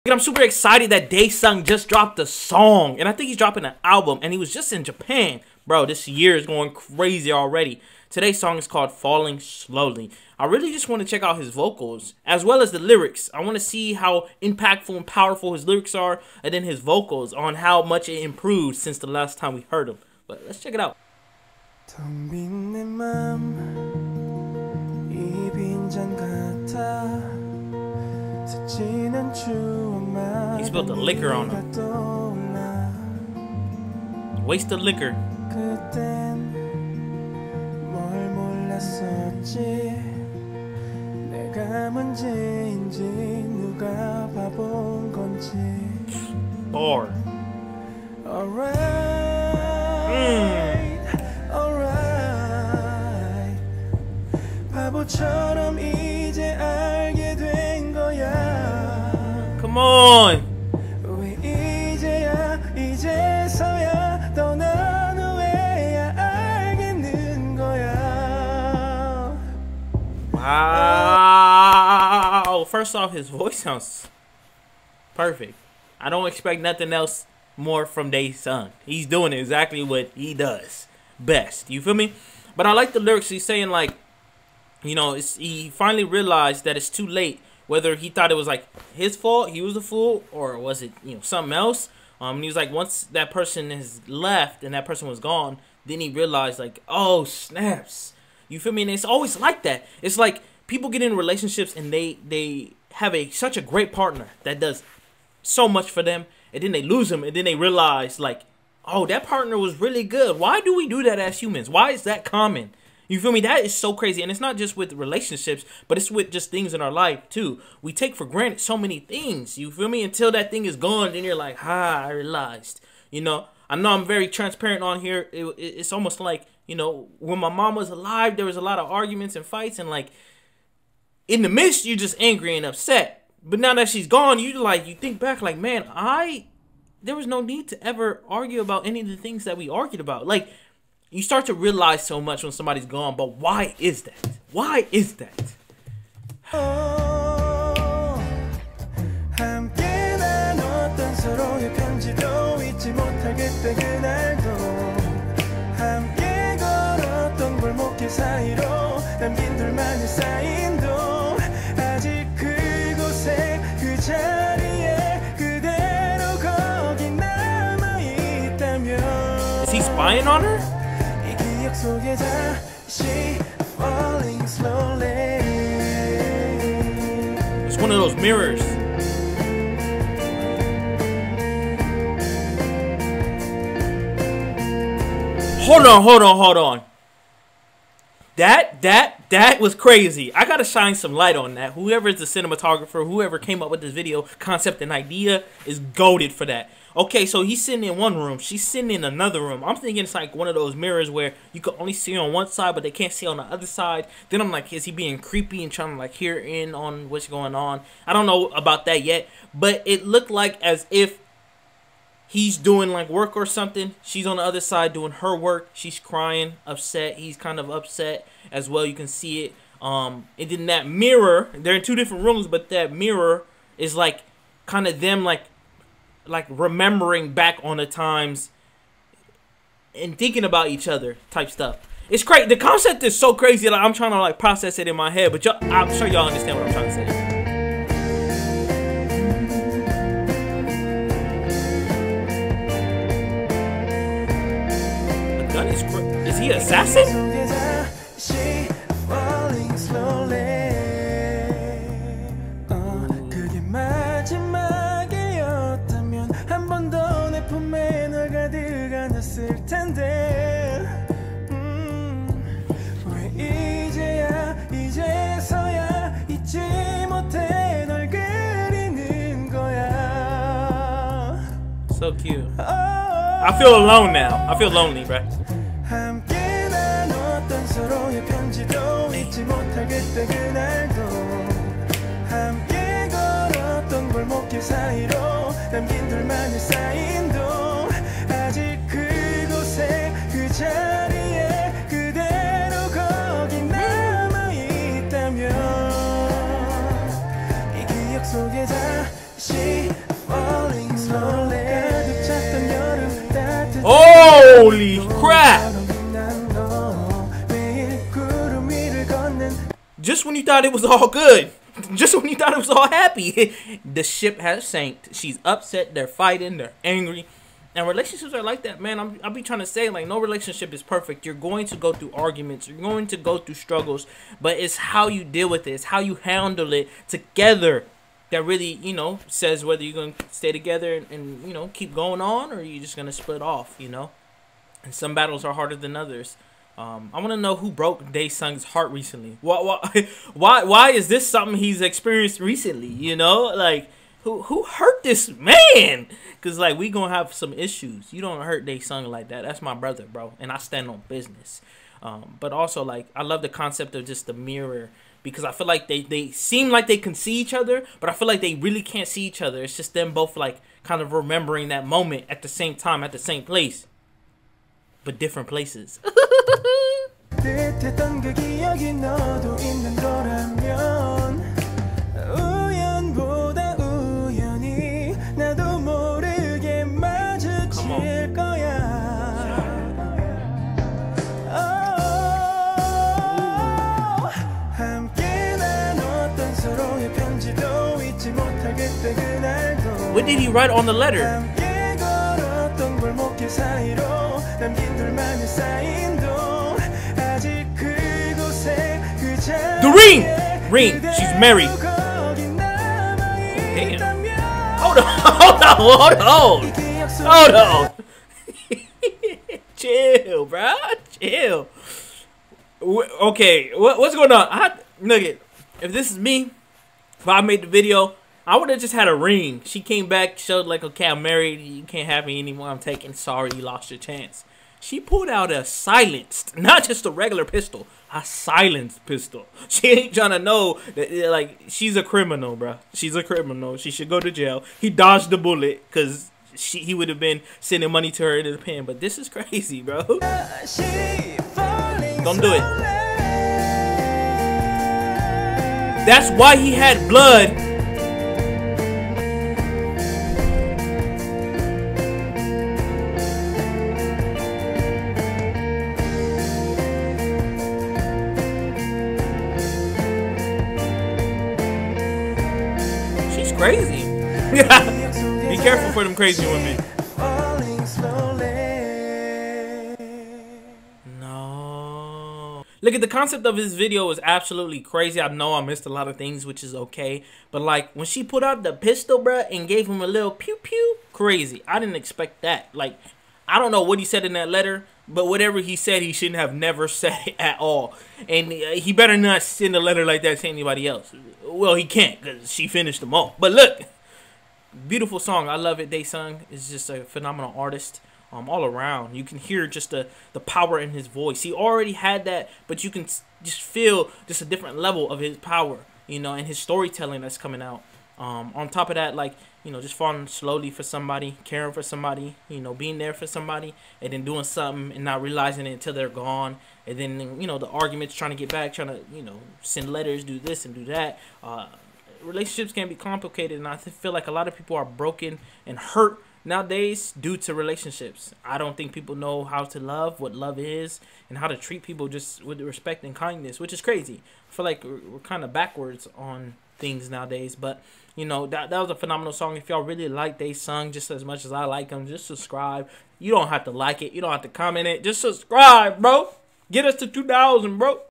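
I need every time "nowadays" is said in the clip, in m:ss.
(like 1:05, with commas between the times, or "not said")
8:46, 8:57.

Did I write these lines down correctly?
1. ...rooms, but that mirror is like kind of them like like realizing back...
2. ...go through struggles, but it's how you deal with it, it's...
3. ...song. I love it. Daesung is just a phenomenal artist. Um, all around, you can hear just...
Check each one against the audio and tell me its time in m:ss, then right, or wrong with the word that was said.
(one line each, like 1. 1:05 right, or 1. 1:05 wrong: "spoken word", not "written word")
1. 3:42 wrong: "remembering", not "realizing"
2. 5:23 right
3. 8:15 right.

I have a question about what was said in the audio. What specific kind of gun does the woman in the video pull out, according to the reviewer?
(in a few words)
Silenced pistol.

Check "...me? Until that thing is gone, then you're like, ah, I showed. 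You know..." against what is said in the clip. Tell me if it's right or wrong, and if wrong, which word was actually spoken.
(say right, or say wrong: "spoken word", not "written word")
wrong: "realized", not "showed".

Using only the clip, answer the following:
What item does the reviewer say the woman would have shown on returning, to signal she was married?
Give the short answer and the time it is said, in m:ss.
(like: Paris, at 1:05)
A ring, at 6:59.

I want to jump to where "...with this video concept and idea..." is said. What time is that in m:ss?
3:13.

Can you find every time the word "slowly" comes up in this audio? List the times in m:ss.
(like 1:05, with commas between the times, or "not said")
0:09, 8:30.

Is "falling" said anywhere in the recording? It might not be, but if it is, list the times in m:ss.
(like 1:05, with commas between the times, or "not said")
0:08, 8:29.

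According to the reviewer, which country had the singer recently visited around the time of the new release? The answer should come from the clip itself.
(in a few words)
Japan.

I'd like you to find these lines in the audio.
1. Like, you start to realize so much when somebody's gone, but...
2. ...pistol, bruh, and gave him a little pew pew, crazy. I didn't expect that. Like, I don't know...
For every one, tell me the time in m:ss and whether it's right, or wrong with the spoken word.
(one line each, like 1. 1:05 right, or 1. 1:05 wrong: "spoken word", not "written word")
1. 2:20 right
2. 7:58 right.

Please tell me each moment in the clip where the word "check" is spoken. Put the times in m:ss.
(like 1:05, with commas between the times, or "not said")
0:11, 0:20.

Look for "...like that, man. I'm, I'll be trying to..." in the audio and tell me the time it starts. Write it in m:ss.
5:18.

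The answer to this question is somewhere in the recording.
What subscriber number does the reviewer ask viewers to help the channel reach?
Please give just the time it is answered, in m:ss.
9:07.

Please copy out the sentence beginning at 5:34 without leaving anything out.
And some battles are harder than others.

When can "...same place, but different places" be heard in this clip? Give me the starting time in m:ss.
6:03.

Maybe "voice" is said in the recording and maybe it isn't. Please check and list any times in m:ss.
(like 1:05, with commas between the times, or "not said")
1:13, 8:21.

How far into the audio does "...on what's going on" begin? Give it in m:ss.
3:26.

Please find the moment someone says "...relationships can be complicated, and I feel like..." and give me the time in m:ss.
8:42.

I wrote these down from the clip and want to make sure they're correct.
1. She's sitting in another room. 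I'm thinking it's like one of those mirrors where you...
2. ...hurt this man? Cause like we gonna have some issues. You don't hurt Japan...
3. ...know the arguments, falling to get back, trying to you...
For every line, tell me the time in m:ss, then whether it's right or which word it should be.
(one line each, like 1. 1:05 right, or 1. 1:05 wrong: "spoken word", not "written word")
1. 3:18 right
2. 5:44 wrong: "Daesung", not "Japan"
3. 8:37 wrong: "trying", not "falling".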